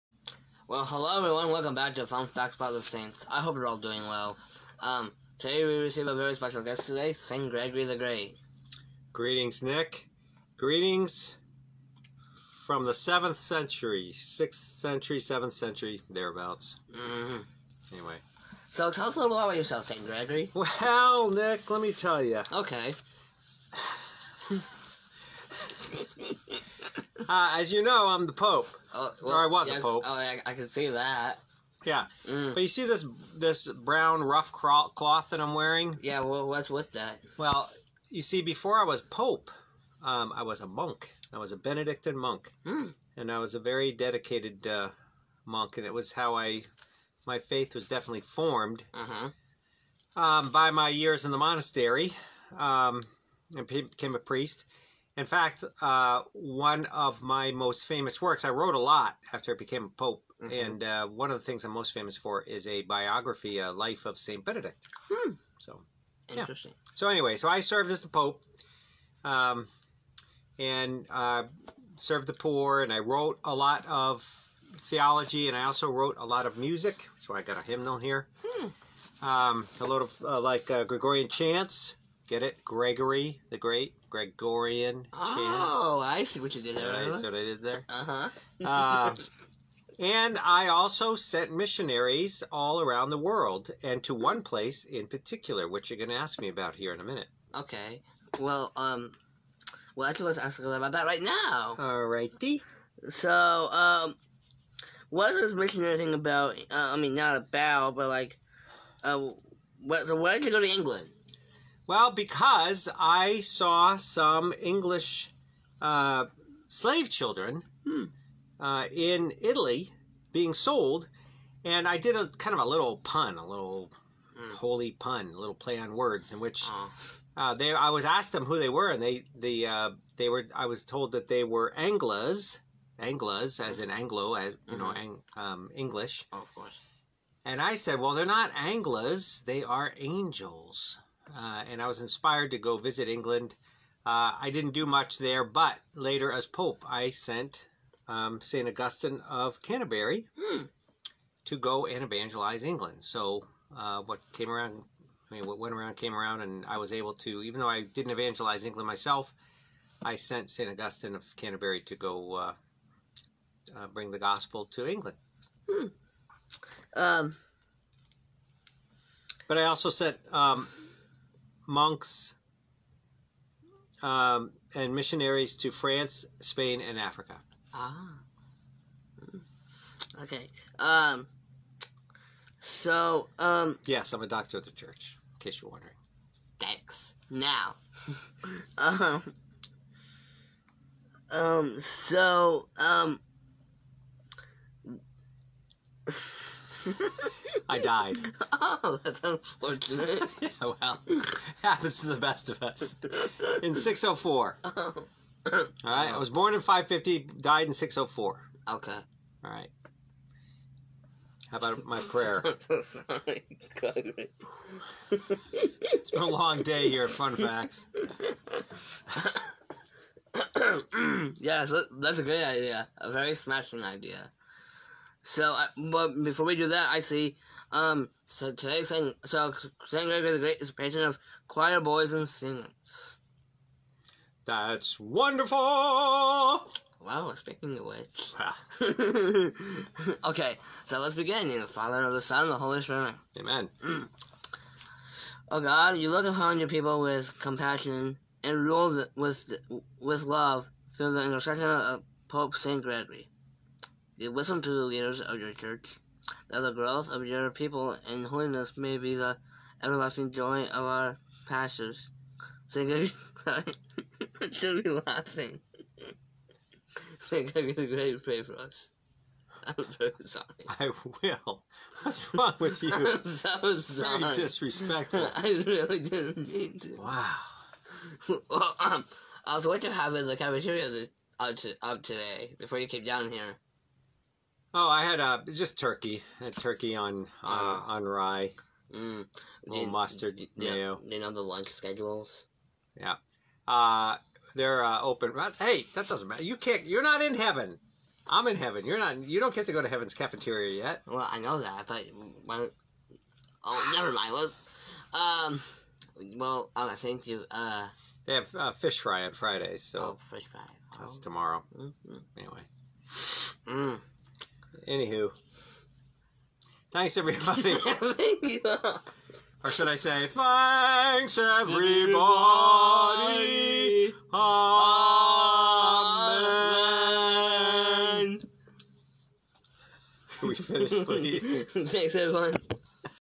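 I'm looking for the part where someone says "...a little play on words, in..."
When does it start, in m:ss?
2:05.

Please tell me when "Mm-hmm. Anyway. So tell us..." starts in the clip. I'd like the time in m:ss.
0:16.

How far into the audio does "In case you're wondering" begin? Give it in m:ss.
3:05.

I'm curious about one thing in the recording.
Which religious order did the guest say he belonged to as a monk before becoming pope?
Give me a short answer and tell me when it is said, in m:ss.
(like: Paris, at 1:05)
Benedictine, at 0:41.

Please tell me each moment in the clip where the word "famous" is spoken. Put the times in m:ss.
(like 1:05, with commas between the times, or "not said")
0:57, 1:01.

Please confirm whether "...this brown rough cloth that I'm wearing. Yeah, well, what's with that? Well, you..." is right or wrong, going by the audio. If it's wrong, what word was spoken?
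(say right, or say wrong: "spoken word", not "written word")
right.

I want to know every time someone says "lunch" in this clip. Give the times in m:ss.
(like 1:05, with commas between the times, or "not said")
4:51.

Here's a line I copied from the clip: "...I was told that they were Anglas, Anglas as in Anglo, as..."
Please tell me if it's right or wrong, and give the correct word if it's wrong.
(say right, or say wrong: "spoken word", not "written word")
right.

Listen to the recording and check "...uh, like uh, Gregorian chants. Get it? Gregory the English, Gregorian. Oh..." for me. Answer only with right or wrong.
wrong.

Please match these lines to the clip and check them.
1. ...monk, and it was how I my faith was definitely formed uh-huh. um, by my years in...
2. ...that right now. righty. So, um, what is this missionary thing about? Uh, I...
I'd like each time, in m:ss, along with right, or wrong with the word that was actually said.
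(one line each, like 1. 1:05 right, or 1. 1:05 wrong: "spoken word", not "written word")
1. 0:45 right
2. 1:40 right.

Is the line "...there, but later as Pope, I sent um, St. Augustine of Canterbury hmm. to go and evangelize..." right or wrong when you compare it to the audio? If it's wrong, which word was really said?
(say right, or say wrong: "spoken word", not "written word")
right.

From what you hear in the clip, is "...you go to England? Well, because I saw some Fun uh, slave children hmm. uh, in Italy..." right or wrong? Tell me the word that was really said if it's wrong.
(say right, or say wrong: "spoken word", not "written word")
wrong: "English", not "Fun".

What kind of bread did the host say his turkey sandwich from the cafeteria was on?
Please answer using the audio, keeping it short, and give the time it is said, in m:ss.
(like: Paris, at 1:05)
rye, at 4:48.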